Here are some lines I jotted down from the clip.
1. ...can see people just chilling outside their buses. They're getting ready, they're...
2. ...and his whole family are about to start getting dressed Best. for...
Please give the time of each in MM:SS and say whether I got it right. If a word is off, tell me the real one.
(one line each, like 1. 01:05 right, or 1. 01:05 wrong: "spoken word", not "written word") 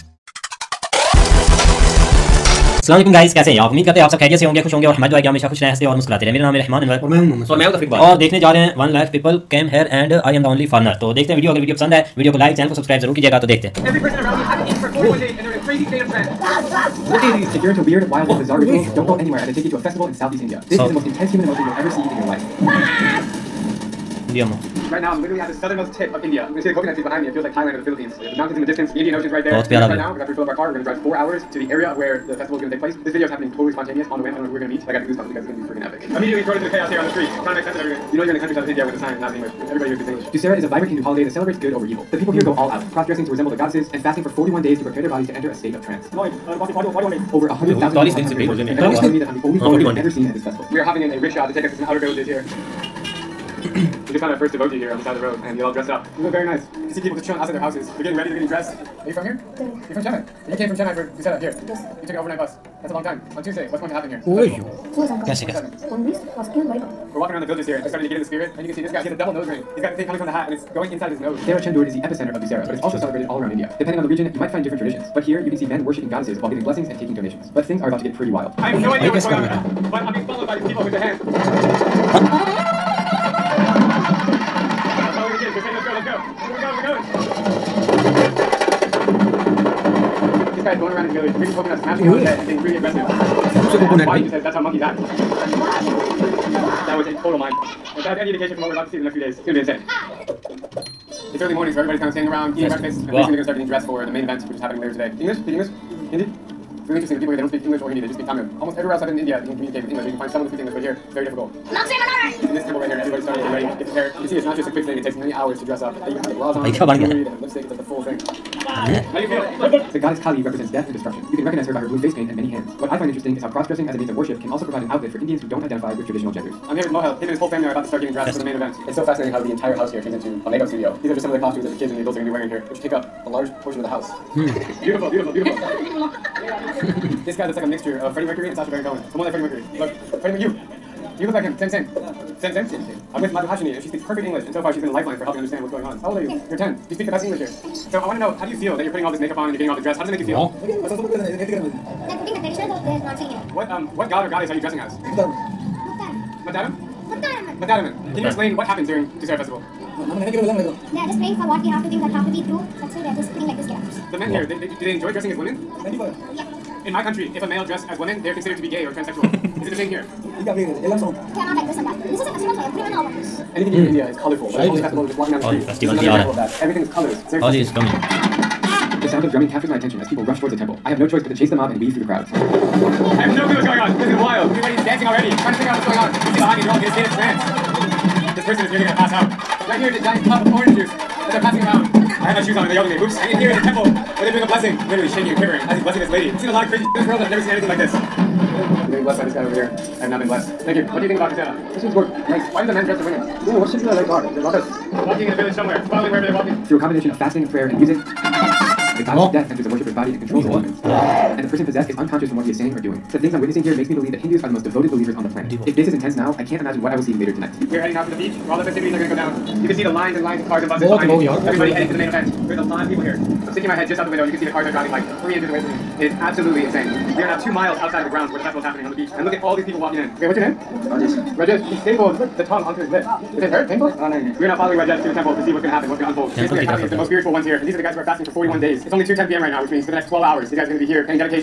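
1. 00:56 wrong: "houses", not "buses"
2. 02:07 right.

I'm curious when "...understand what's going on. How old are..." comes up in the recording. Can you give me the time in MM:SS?
02:25.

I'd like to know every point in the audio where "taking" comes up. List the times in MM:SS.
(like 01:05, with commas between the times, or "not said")
01:16.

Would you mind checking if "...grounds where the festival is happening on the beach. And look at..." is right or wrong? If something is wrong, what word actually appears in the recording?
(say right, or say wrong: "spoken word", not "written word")
right.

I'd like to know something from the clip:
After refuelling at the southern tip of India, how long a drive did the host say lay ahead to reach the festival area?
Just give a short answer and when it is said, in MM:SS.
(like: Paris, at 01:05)
4 hours, at 00:31.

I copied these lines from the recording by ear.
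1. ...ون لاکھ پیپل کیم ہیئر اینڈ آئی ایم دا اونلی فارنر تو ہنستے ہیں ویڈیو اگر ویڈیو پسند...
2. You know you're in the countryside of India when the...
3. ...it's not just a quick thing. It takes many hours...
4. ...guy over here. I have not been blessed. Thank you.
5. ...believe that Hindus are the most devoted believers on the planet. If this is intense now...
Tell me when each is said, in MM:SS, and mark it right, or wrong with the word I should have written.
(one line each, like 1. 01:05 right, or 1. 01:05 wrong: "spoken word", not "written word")
1. 00:08 wrong: "دیکھتے", not "ہنستے"
2. 00:38 right
3. 01:54 right
4. 03:19 right
5. 03:33 right.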